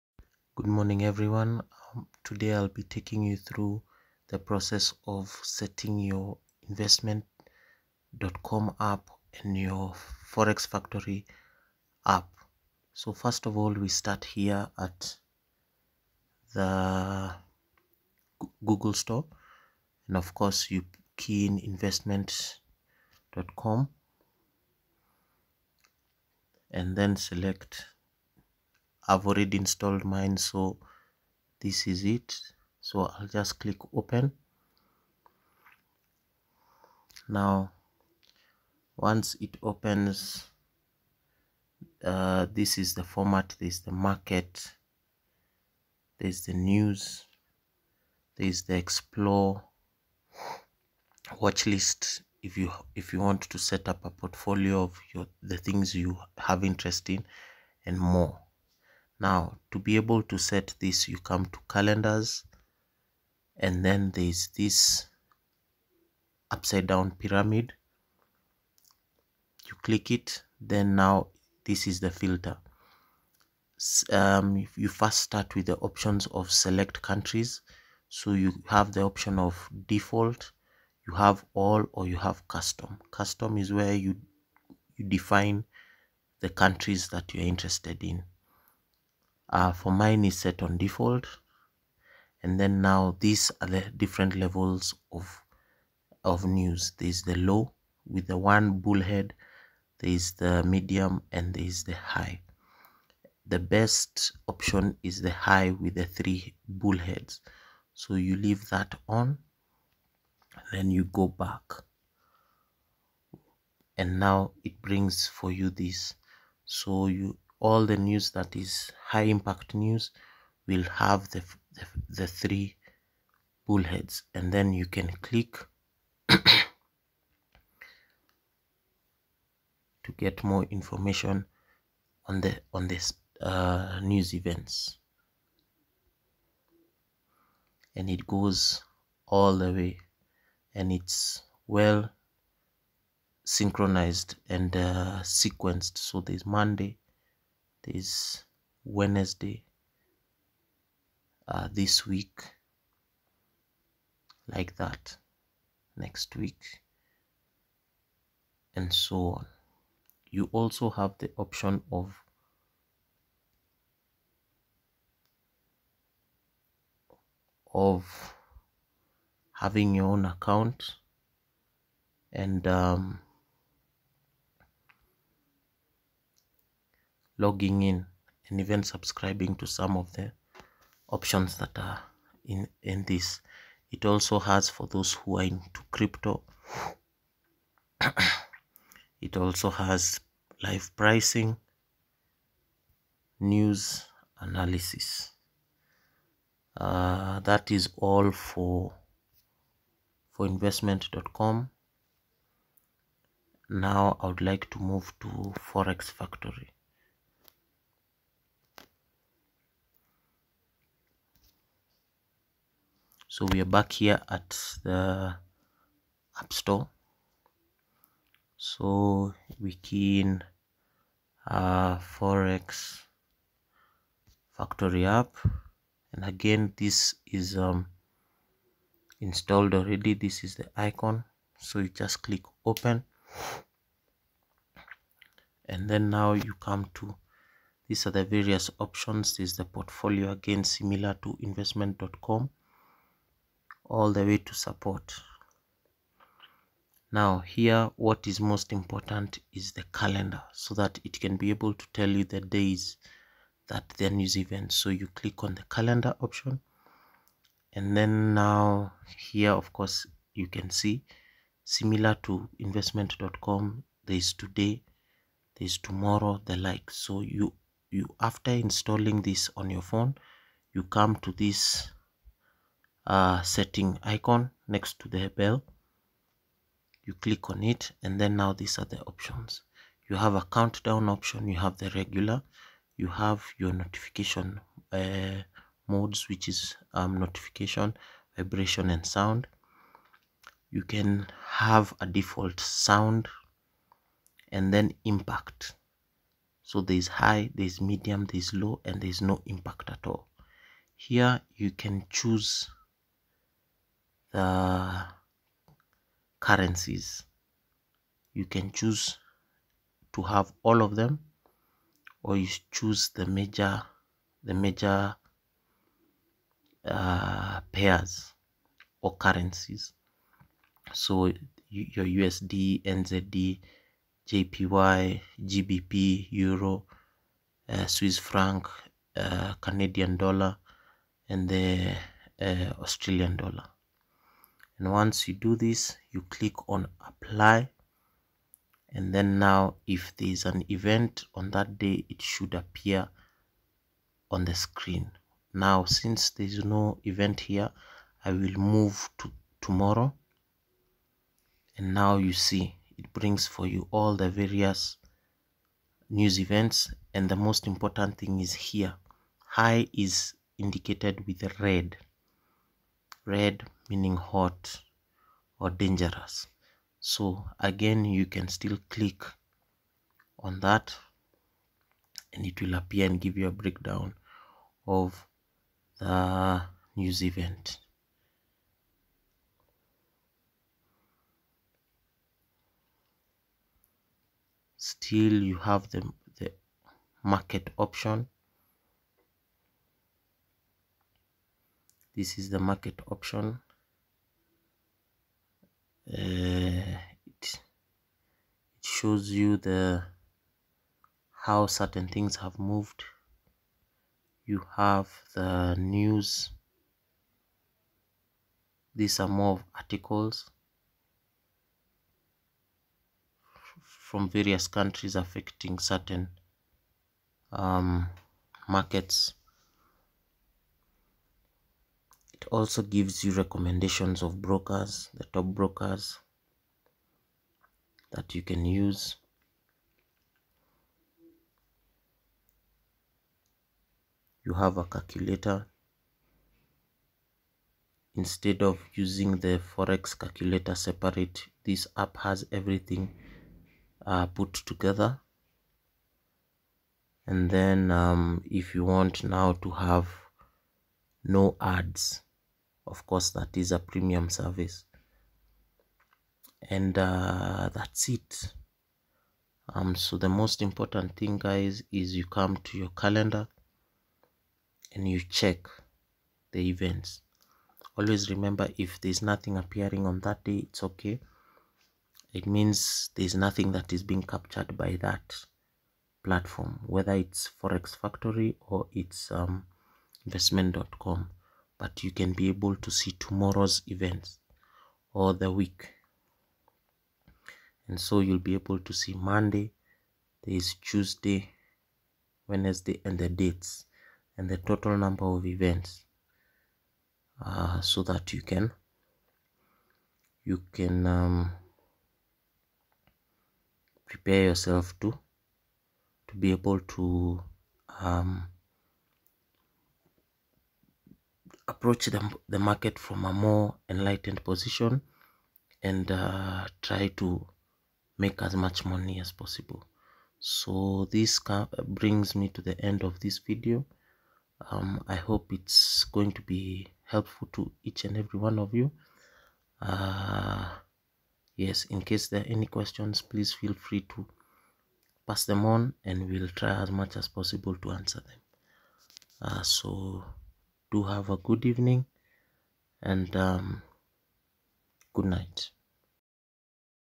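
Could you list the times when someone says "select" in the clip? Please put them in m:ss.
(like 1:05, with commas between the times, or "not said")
0:27, 1:16.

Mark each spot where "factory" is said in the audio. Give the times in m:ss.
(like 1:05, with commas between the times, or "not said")
0:10, 3:26, 3:44, 7:57.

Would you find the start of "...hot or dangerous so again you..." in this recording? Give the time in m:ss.
6:04.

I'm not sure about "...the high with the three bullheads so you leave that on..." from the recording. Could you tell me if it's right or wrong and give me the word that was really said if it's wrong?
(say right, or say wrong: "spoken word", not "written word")
right.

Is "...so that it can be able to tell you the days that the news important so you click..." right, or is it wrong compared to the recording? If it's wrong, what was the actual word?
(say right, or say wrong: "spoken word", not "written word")
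wrong: "event", not "important".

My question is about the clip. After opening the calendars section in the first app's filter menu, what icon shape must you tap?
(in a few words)
Upside down pyramid.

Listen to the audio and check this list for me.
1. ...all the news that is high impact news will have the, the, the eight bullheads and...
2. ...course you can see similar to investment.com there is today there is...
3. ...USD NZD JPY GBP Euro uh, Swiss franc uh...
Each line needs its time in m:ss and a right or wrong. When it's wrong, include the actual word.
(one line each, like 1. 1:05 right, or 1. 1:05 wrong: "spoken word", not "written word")
1. 1:57 wrong: "three", not "eight"
2. 4:19 right
3. 5:22 right.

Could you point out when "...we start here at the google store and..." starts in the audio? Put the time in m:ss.
0:13.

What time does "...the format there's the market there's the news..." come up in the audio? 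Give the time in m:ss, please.
0:42.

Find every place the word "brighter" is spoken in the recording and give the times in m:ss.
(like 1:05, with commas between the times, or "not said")
not said.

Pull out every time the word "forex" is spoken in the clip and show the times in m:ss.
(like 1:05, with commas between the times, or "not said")
0:10, 3:25, 3:41, 7:19, 7:57.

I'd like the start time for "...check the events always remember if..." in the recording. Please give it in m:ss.
7:45.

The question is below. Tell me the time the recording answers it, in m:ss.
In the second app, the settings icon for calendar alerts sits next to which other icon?
4:34.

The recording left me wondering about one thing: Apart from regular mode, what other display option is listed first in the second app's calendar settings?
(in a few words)
Countdown.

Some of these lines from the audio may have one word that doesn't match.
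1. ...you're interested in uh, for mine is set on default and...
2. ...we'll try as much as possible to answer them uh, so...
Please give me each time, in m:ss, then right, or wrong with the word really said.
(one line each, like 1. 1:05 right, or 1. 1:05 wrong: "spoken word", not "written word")
1. 1:27 right
2. 8:56 right.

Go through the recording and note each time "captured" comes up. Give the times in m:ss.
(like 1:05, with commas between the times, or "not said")
7:54.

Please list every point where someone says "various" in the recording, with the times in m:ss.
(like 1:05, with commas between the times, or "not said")
3:58, 5:54, 6:54.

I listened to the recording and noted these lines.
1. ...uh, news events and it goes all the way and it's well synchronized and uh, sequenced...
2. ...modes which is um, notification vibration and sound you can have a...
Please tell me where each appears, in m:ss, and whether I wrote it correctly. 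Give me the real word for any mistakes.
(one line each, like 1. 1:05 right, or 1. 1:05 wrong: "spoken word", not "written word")
1. 2:13 right
2. 4:45 right.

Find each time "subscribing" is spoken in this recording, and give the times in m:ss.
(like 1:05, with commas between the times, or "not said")
2:58.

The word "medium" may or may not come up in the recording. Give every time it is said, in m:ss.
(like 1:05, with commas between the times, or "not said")
1:40, 4:57.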